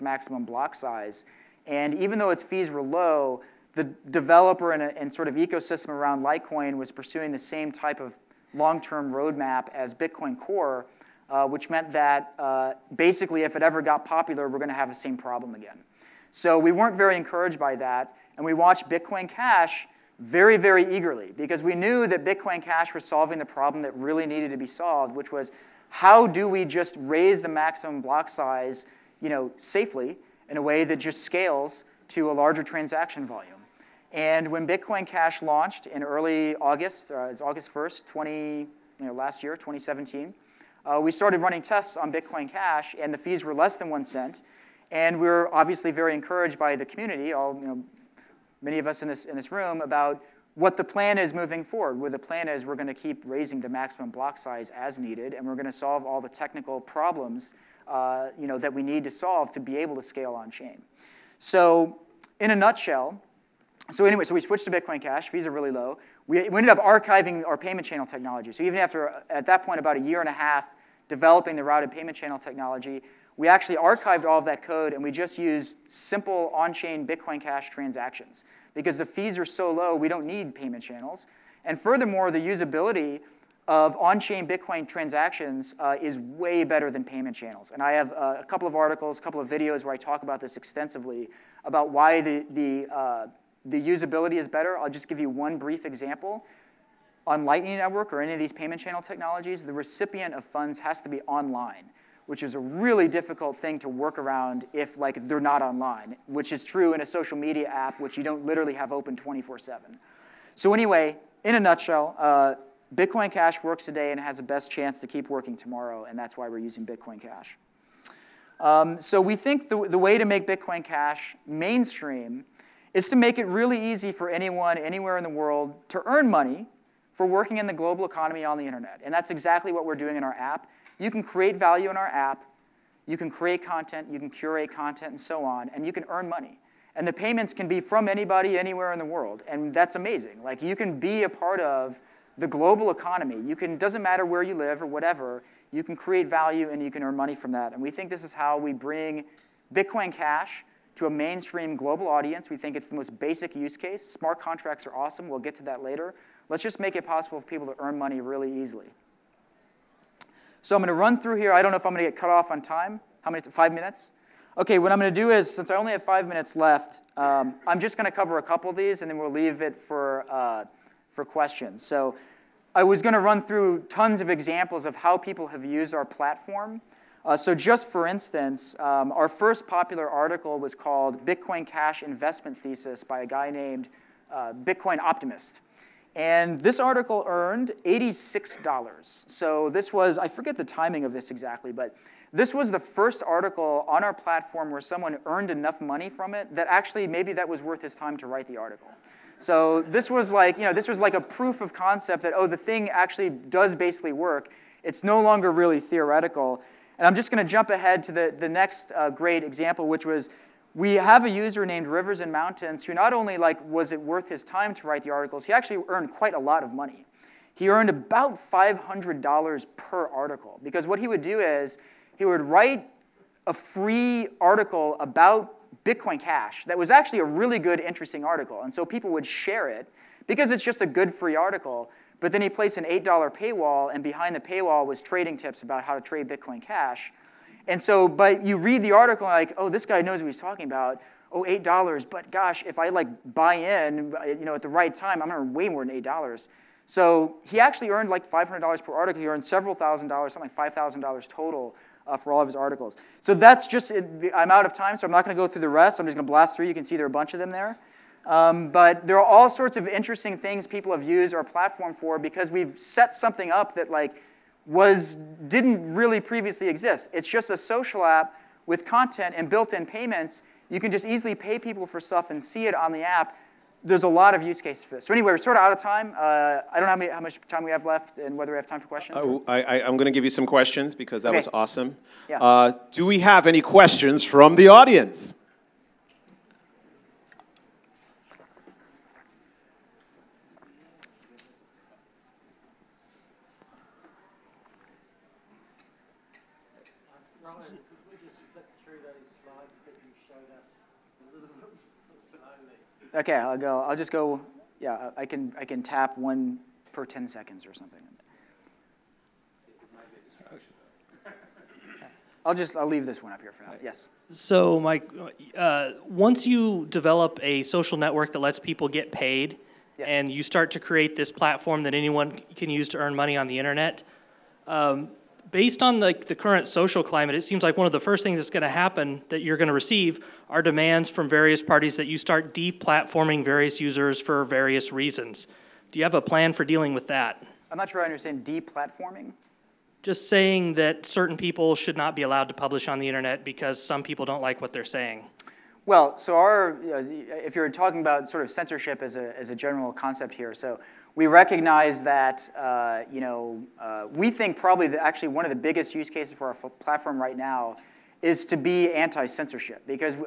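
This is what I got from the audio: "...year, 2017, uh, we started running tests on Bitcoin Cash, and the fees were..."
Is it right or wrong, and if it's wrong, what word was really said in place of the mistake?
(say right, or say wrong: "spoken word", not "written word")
right.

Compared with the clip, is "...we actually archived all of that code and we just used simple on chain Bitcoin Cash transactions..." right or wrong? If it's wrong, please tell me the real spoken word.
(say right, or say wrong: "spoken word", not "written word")
right.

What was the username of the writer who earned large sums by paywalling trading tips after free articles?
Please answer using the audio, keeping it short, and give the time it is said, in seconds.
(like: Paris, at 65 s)
Rivers and Mountains, at 211 s.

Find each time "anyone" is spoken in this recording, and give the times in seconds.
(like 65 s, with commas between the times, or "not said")
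124 s, 321 s.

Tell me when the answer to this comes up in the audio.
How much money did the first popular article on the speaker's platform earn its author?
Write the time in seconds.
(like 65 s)
187 s.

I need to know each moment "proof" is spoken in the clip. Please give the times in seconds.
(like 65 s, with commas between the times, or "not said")
201 s.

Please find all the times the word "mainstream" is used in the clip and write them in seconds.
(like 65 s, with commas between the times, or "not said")
121 s, 151 s.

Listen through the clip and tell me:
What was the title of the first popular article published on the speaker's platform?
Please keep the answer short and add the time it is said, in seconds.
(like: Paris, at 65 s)
Bitcoin Cash Investment Thesis, at 181 s.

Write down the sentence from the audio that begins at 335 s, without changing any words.
Do you have a plan for dealing with that?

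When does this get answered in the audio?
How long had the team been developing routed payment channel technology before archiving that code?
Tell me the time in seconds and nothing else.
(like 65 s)
69 s.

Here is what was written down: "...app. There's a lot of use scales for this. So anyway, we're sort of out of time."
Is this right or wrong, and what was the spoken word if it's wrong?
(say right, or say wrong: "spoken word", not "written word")
wrong: "cases", not "scales".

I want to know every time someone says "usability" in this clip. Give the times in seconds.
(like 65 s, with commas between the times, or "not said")
82 s, 93 s.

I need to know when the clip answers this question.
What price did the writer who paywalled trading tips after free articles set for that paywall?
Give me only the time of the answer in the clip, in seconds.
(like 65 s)
232 s.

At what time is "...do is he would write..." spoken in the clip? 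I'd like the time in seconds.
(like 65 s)
221 s.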